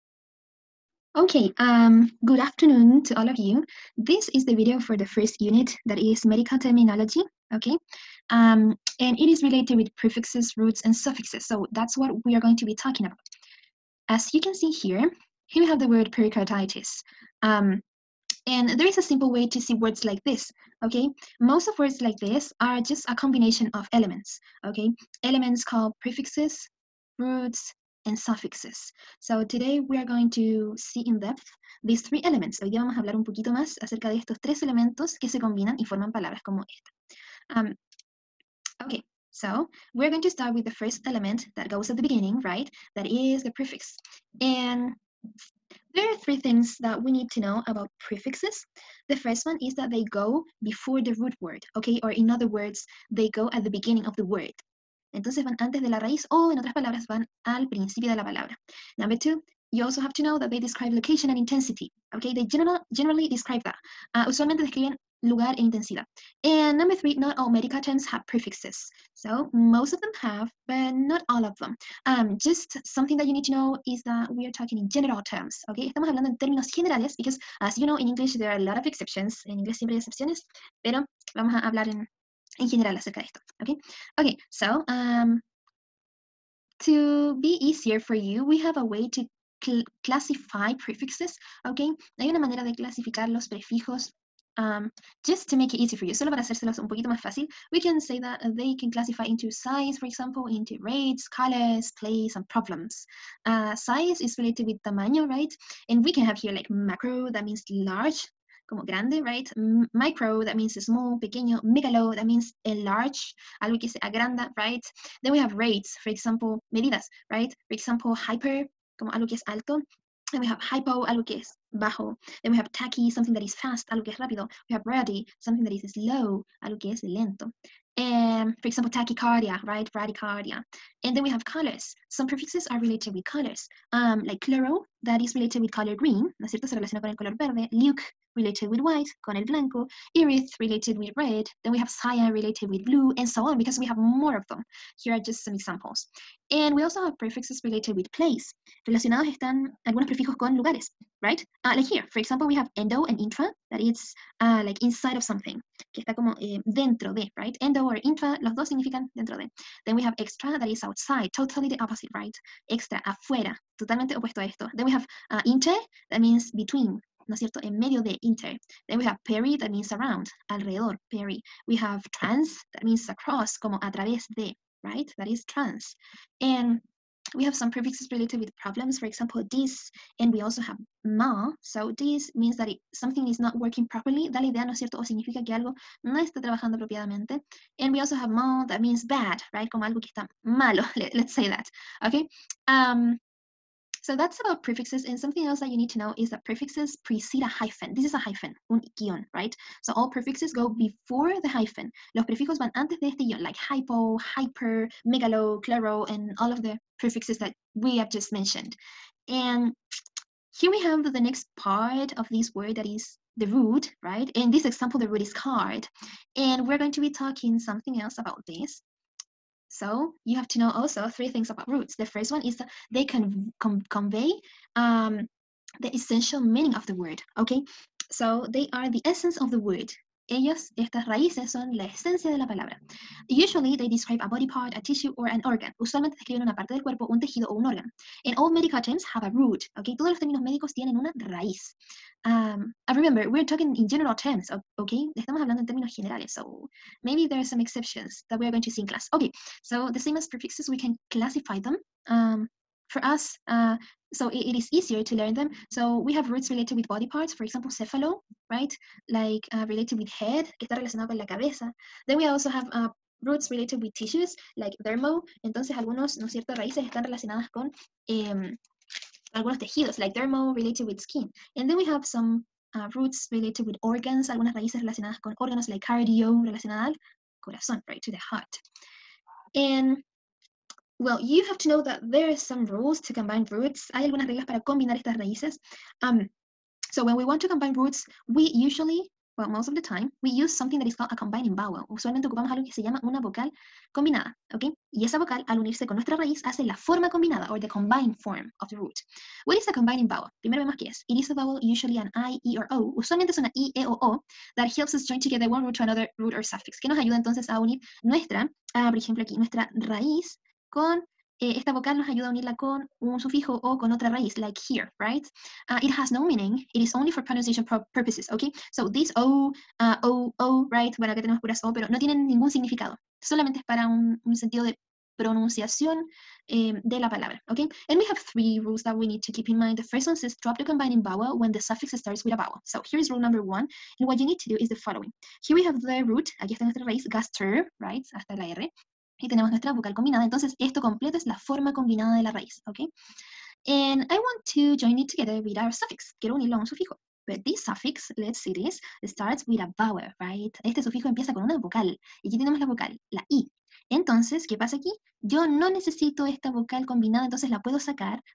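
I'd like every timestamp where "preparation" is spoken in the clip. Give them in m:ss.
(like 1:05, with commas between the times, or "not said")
not said.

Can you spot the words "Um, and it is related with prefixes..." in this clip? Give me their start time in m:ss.
0:08.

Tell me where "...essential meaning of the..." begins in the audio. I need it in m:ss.
3:45.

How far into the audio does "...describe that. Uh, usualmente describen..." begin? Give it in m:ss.
1:03.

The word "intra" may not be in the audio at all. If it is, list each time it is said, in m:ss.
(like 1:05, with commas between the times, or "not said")
2:33, 2:38.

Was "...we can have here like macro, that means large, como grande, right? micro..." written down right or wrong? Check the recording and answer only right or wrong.
right.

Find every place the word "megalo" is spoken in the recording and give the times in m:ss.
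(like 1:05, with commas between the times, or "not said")
1:51, 3:25.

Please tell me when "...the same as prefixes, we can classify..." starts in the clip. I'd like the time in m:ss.
4:09.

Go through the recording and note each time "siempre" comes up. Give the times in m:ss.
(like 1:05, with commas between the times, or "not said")
1:19.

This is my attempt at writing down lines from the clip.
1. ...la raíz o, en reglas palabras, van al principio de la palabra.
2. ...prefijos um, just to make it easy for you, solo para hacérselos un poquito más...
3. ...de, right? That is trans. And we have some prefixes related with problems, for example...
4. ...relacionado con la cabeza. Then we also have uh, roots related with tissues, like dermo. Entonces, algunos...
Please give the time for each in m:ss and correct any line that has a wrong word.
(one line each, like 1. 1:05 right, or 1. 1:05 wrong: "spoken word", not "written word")
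1. 0:55 wrong: "otras", not "reglas"
2. 1:33 right
3. 2:54 right
4. 4:20 right.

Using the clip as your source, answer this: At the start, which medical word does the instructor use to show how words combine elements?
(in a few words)
pericarditis.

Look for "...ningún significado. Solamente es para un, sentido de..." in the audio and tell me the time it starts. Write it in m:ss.
5:22.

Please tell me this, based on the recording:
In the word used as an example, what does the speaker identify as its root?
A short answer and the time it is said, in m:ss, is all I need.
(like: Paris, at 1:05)
card, at 3:35.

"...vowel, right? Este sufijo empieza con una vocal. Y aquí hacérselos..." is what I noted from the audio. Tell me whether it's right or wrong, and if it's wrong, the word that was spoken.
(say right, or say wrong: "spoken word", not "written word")
wrong: "tenemos", not "hacérselos".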